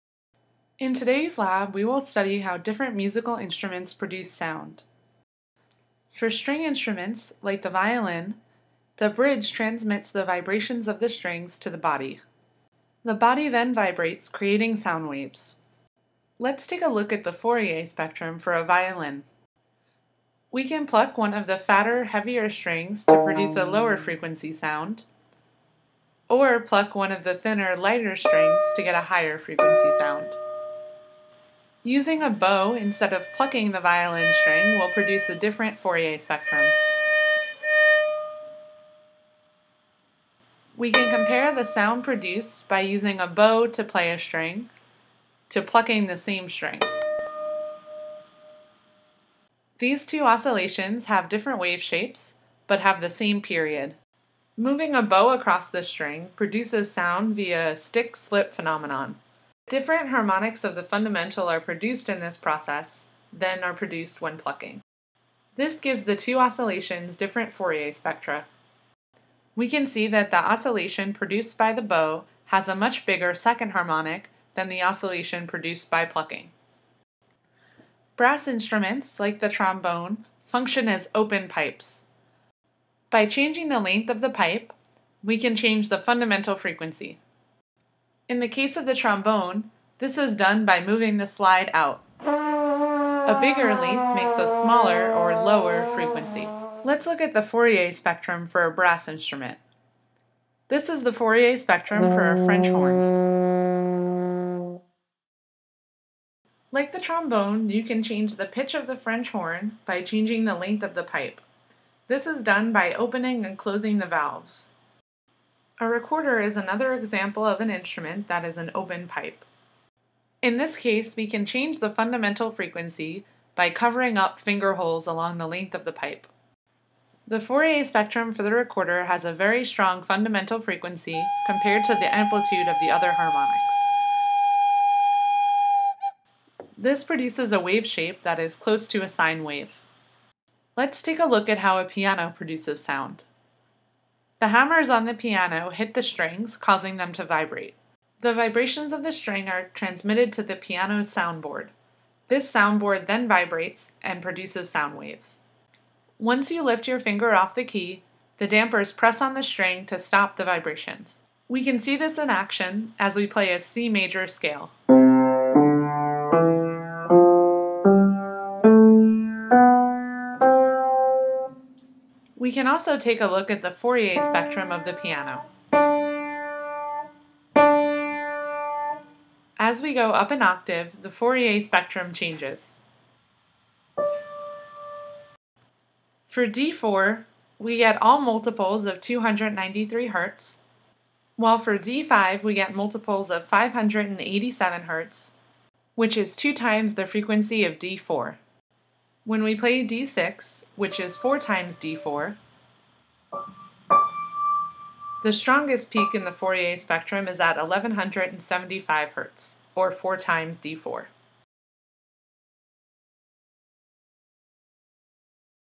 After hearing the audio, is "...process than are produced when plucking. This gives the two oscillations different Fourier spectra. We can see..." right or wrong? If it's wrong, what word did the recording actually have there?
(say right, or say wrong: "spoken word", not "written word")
right.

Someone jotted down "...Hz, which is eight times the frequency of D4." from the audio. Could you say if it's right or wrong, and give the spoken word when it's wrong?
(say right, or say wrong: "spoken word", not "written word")
wrong: "two", not "eight".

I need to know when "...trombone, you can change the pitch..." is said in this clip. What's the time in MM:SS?
01:47.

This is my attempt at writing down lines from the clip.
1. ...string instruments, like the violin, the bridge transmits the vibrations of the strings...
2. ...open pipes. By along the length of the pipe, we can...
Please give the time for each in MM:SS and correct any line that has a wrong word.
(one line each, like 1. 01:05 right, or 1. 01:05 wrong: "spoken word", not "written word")
1. 00:06 right
2. 01:21 wrong: "changing", not "along".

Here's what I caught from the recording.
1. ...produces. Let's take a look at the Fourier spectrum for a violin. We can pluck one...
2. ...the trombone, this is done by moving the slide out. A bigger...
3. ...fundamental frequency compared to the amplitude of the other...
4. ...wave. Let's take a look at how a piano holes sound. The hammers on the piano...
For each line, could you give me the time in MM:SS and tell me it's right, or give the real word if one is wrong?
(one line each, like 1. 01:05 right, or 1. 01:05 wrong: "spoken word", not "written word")
1. 00:15 wrong: "waves", not "produces"
2. 01:28 right
3. 02:10 right
4. 02:19 wrong: "produces", not "holes".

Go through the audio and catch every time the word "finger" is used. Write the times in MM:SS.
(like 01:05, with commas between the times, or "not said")
02:04, 02:36.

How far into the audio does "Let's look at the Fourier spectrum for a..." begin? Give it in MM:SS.
01:36.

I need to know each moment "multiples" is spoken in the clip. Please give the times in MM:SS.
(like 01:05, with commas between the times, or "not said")
03:08, 03:12.